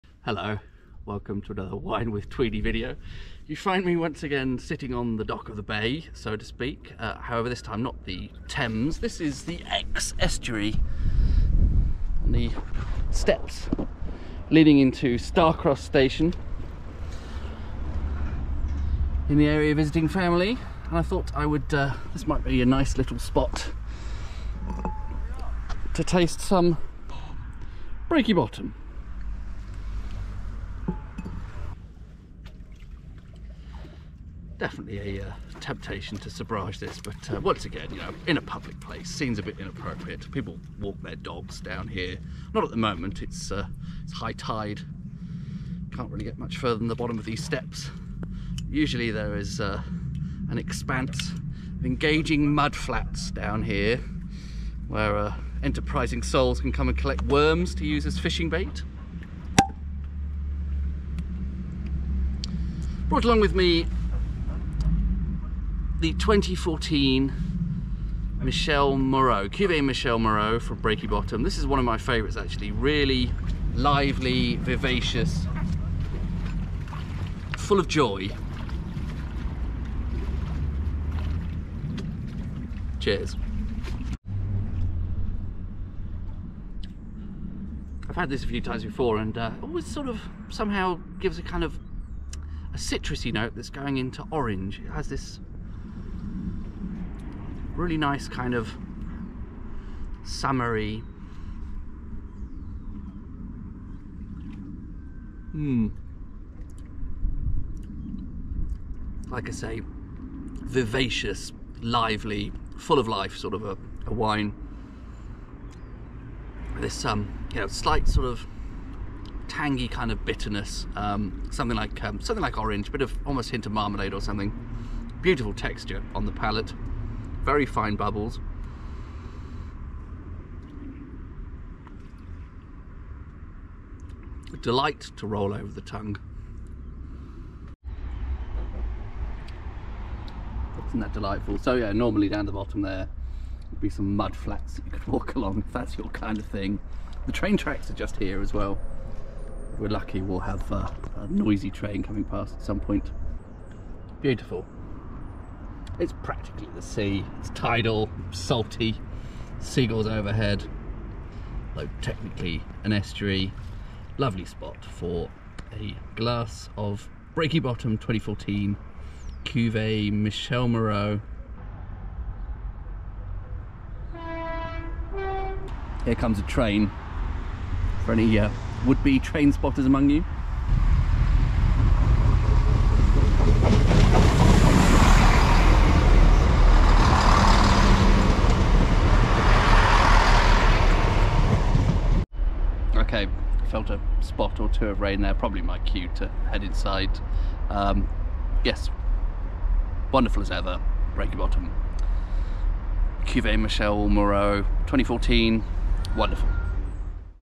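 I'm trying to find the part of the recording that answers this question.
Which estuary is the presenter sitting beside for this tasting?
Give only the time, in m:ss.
0:09.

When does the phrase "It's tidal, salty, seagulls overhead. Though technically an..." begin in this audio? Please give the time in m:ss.
2:37.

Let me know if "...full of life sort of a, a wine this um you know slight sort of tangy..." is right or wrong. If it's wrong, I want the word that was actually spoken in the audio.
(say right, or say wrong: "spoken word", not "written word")
right.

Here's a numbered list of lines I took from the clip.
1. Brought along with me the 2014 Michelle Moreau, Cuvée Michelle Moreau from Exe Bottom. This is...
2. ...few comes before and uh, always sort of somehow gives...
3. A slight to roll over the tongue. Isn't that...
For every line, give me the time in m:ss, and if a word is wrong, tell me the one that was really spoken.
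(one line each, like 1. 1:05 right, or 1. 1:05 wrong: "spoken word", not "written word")
1. 1:03 wrong: "Breaky", not "Exe"
2. 1:28 wrong: "times", not "comes"
3. 2:14 wrong: "delight", not "slight".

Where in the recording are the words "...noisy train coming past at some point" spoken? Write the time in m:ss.
2:31.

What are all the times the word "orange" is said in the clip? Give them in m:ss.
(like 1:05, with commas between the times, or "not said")
1:34, 2:02.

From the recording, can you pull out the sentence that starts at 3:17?
Um, yes, wonderful as ever, Breaky Bottom.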